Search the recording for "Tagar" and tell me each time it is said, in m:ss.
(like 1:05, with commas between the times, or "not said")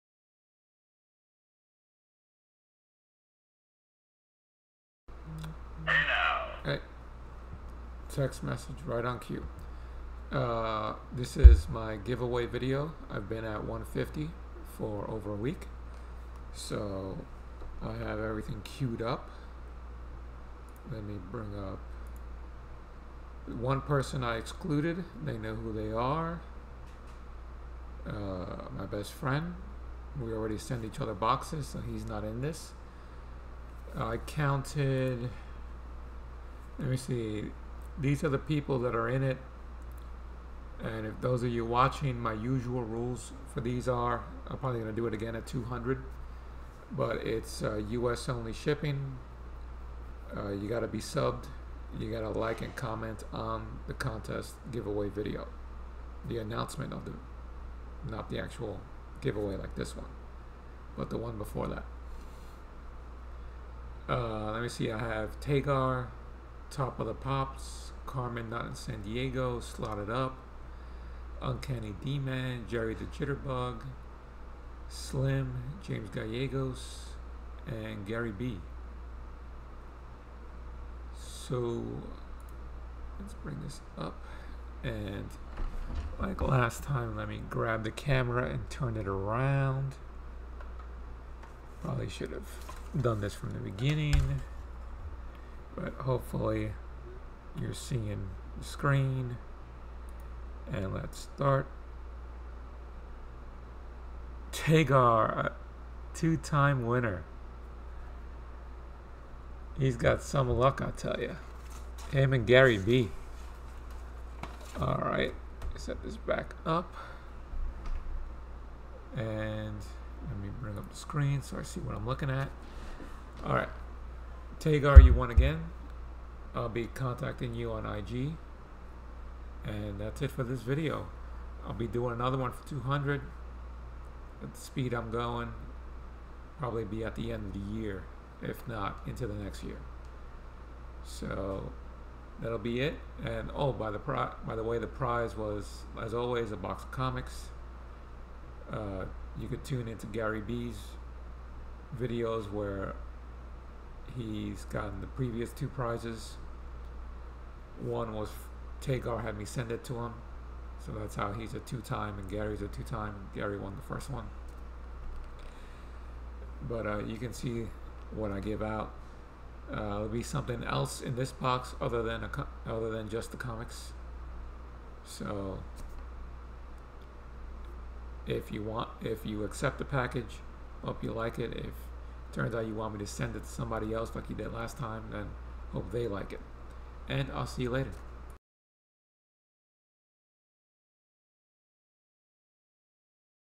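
1:05, 1:44, 2:04, 2:38.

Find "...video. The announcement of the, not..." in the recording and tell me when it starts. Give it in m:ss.
0:55.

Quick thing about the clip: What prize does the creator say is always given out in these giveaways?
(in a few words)
A box of comics.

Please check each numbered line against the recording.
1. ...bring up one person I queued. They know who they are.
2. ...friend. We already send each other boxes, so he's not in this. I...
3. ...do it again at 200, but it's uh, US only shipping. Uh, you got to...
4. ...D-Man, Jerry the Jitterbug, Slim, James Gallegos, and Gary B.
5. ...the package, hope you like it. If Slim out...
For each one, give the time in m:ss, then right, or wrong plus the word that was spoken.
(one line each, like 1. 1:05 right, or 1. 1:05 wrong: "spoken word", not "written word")
1. 0:21 wrong: "excluded", not "queued"
2. 0:29 right
3. 0:44 right
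4. 1:12 right
5. 2:59 wrong: "Turns", not "Slim".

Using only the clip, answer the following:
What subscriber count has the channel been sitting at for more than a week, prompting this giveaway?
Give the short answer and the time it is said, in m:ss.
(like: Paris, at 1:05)
150, at 0:13.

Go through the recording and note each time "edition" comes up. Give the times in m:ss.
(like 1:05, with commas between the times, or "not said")
not said.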